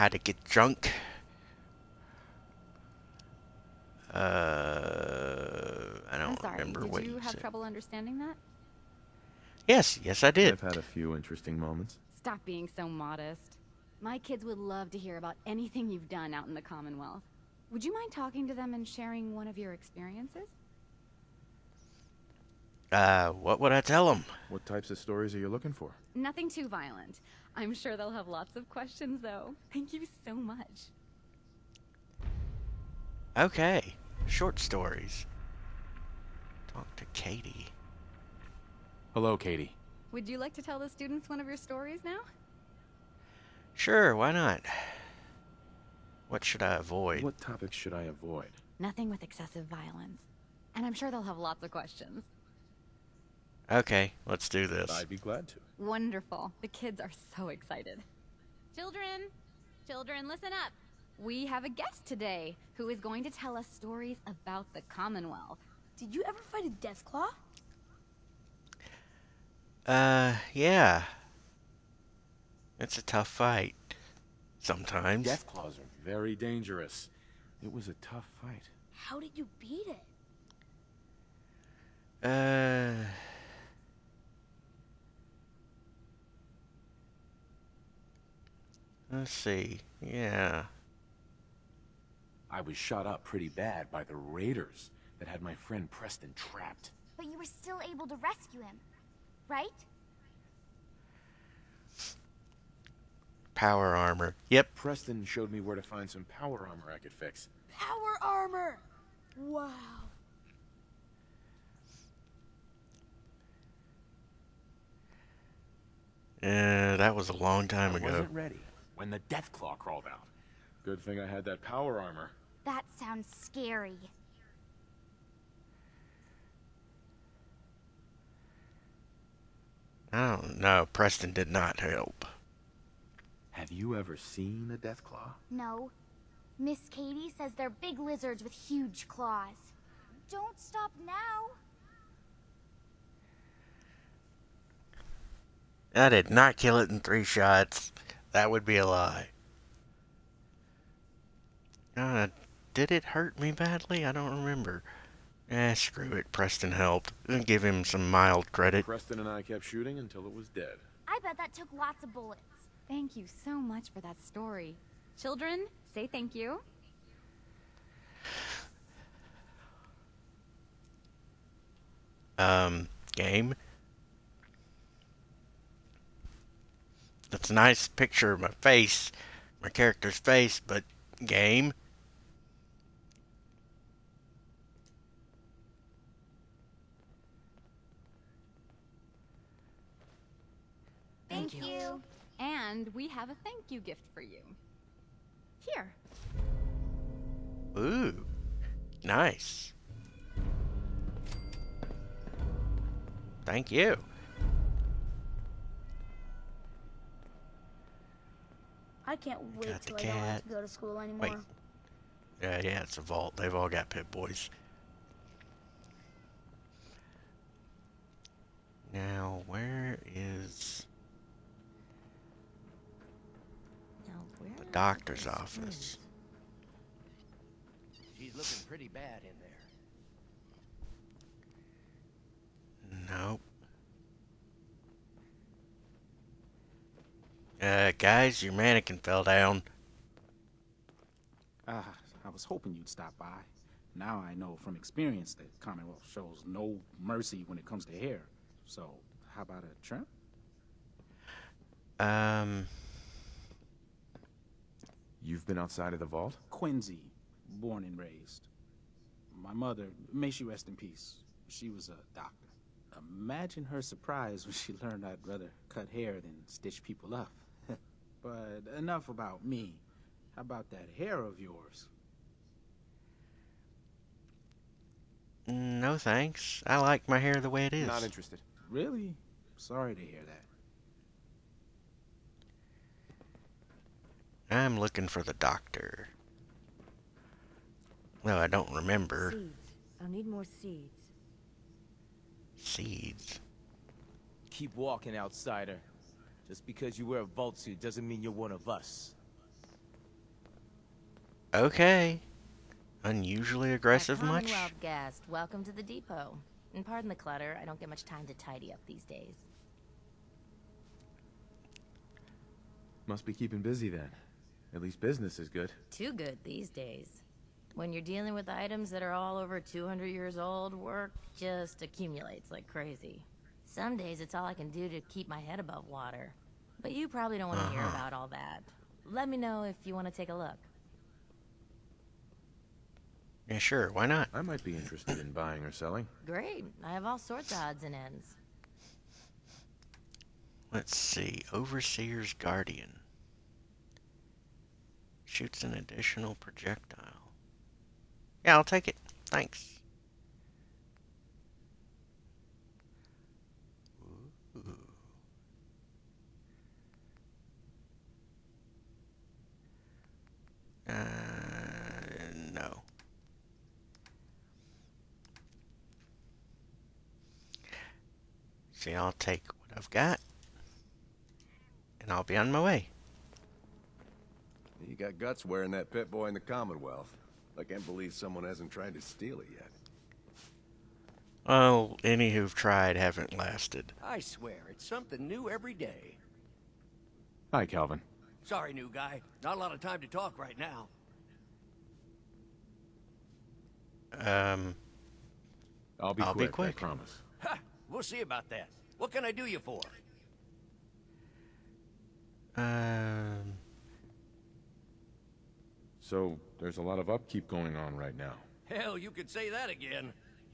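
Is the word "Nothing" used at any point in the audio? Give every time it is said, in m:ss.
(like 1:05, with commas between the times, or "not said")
0:26, 0:48.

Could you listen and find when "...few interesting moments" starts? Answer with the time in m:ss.
0:10.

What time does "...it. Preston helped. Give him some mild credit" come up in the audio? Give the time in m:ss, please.
2:36.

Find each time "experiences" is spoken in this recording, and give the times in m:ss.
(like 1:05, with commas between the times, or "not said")
0:19, 4:04.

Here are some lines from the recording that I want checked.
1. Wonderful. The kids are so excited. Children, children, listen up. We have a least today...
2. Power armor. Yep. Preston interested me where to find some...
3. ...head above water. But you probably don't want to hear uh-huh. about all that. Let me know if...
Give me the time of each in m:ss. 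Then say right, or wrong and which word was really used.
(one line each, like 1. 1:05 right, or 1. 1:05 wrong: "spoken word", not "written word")
1. 0:55 wrong: "guest", not "least"
2. 1:43 wrong: "showed", not "interested"
3. 5:25 right.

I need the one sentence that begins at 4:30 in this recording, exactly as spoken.
How about that hair of yours?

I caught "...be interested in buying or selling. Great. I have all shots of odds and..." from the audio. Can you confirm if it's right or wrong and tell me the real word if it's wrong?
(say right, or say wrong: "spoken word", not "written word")
wrong: "sorts", not "shots".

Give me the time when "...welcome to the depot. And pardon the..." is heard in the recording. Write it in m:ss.
5:05.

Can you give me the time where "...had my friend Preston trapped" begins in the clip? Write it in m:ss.
1:35.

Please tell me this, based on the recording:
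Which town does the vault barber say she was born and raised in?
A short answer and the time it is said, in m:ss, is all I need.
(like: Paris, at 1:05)
Quincy, at 4:16.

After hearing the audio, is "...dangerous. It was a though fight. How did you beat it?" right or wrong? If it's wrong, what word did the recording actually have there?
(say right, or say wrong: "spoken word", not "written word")
wrong: "tough", not "though".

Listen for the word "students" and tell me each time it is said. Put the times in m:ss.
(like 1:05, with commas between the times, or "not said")
0:40.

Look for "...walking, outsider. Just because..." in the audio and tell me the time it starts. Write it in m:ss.
4:54.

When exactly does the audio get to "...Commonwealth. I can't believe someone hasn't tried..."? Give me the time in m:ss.
6:16.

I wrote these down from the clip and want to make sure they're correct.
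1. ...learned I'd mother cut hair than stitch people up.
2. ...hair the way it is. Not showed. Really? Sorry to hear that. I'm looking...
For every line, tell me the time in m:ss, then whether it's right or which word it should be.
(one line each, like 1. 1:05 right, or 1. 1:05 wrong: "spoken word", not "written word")
1. 4:24 wrong: "rather", not "mother"
2. 4:37 wrong: "interested", not "showed".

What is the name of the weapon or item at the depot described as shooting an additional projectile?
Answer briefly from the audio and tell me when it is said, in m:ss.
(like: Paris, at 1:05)
Overseer's Guardian, at 5:41.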